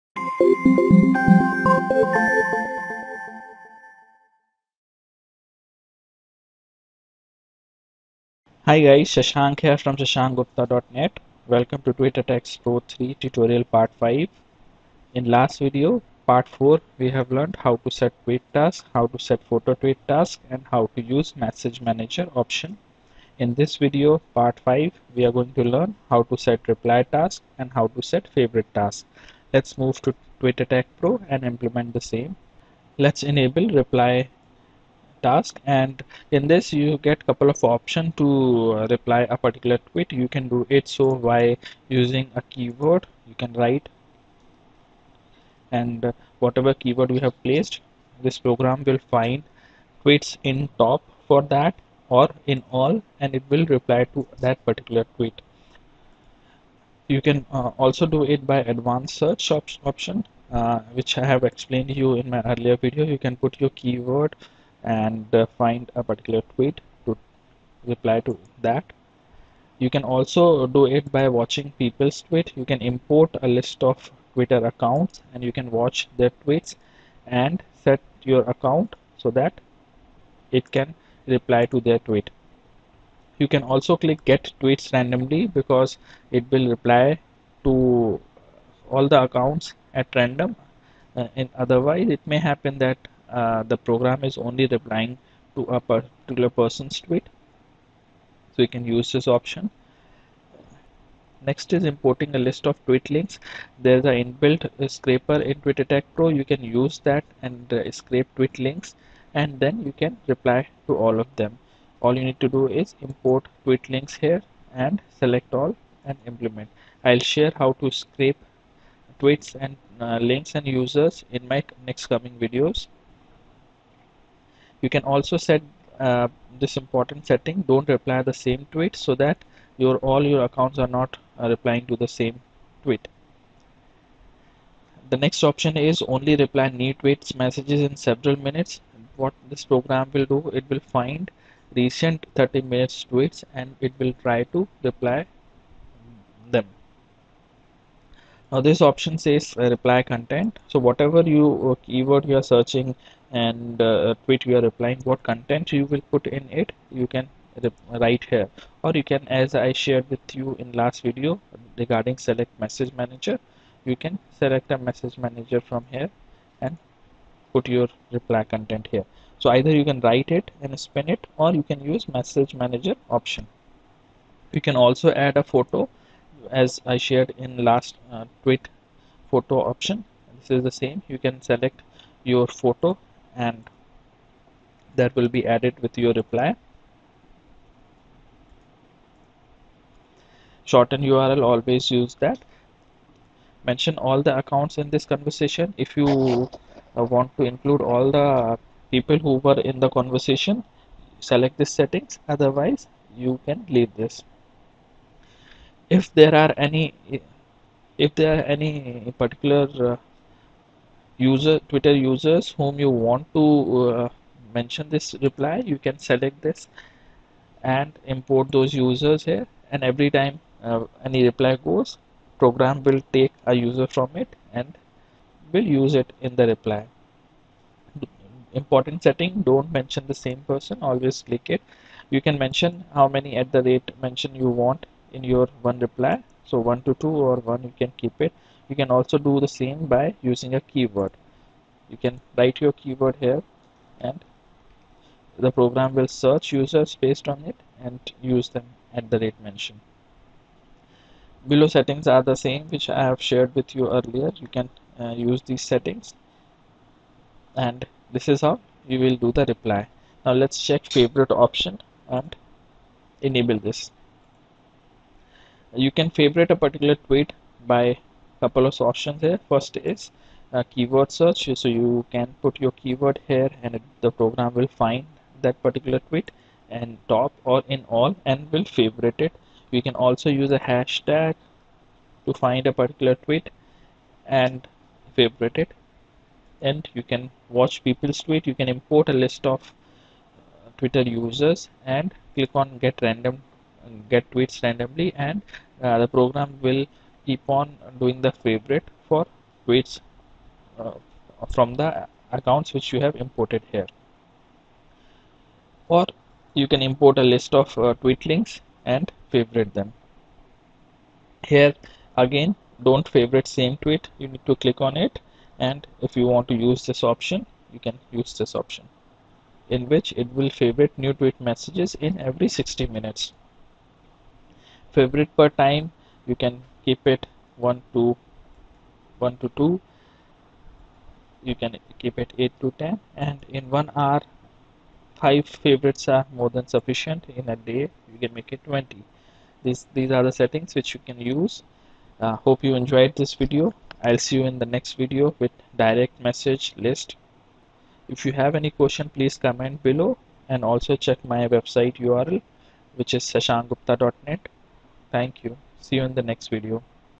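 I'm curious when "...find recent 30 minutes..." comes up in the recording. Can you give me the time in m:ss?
2:20.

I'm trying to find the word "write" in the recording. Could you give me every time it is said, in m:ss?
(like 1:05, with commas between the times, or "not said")
0:43, 2:38, 2:50, 4:02.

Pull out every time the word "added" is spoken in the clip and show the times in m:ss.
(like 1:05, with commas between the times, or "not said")
3:05.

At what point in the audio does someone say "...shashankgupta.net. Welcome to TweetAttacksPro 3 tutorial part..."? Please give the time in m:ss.
0:09.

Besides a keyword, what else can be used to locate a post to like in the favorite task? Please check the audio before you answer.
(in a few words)
hashtag.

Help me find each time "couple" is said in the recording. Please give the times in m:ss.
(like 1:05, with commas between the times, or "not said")
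0:37, 4:28.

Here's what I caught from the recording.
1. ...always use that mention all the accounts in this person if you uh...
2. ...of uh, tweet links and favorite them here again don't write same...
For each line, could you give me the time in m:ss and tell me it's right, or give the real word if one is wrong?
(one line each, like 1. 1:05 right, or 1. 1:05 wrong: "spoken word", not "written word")
1. 3:11 wrong: "conversation", not "person"
2. 5:07 wrong: "favorite", not "write".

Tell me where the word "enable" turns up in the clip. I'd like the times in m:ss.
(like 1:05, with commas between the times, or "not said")
0:33, 4:23.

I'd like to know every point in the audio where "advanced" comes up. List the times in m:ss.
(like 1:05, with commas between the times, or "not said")
0:58.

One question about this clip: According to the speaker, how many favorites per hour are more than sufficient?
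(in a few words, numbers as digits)
5.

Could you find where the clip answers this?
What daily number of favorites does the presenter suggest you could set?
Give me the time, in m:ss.
5:38.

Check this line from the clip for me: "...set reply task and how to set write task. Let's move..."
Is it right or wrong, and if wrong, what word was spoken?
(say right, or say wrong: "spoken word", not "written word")
wrong: "favorite", not "write".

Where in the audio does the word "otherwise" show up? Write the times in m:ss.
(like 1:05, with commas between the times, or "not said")
1:31, 3:22.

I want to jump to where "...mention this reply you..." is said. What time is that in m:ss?
3:34.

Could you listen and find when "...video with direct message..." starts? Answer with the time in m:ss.
5:45.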